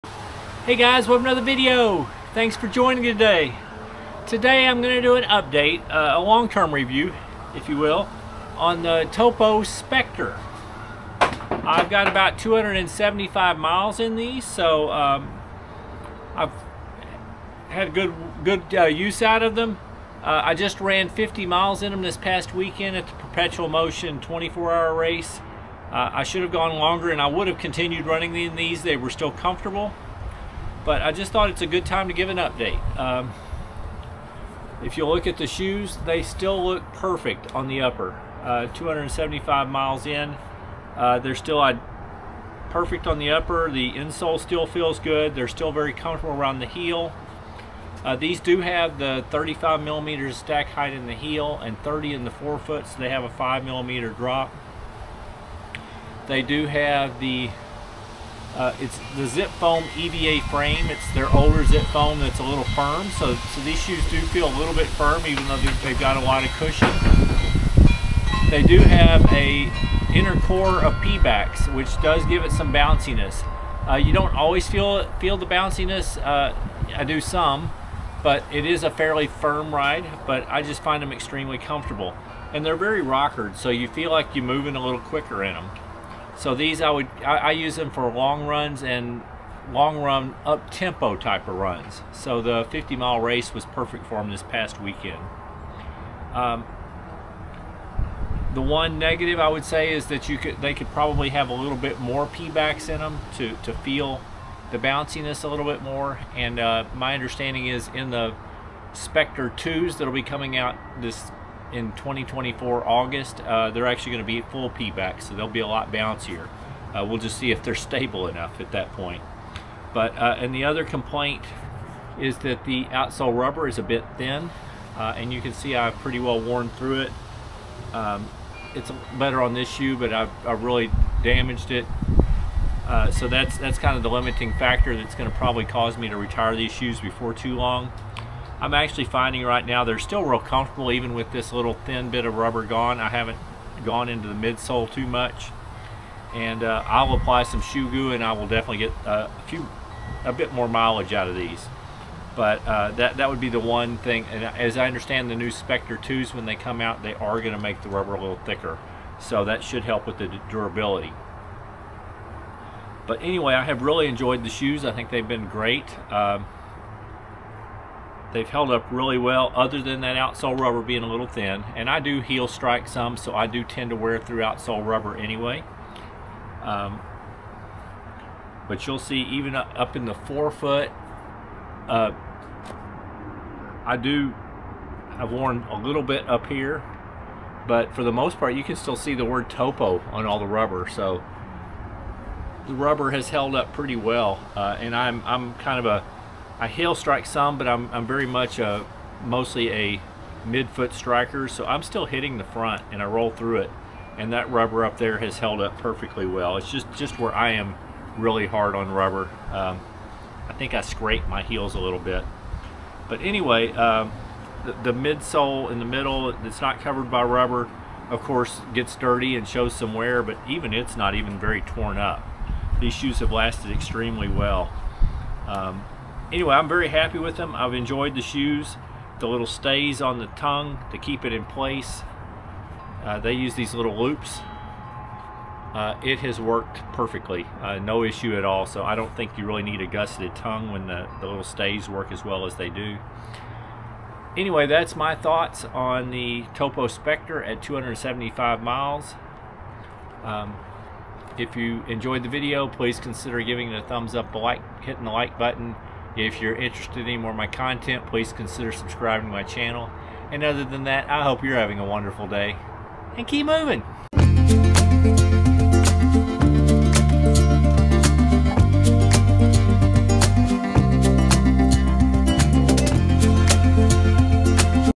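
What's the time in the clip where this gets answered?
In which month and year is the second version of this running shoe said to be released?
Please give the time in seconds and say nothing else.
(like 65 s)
111 s.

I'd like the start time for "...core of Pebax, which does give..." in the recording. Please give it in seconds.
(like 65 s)
70 s.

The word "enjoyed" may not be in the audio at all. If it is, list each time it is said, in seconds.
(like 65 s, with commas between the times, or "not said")
164 s, 227 s, 251 s.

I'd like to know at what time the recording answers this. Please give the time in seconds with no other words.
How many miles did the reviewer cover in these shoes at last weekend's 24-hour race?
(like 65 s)
21 s.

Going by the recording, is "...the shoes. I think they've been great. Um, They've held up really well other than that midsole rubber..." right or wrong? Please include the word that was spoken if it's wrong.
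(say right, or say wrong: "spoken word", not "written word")
wrong: "outsole", not "midsole".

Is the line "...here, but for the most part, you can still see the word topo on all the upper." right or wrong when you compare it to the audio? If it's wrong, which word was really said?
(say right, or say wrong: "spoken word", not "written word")
wrong: "rubber", not "upper".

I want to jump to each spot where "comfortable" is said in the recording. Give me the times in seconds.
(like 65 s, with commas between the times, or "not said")
29 s, 45 s, 81 s, 140 s.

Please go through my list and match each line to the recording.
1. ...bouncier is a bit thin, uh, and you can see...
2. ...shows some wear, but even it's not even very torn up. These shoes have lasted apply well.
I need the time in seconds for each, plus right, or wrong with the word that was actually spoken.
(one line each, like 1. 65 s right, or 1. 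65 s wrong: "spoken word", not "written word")
1. 123 s wrong: "rubber", not "bouncier"
2. 219 s wrong: "extremely", not "apply".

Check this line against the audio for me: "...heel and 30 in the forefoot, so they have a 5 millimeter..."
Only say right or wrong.
right.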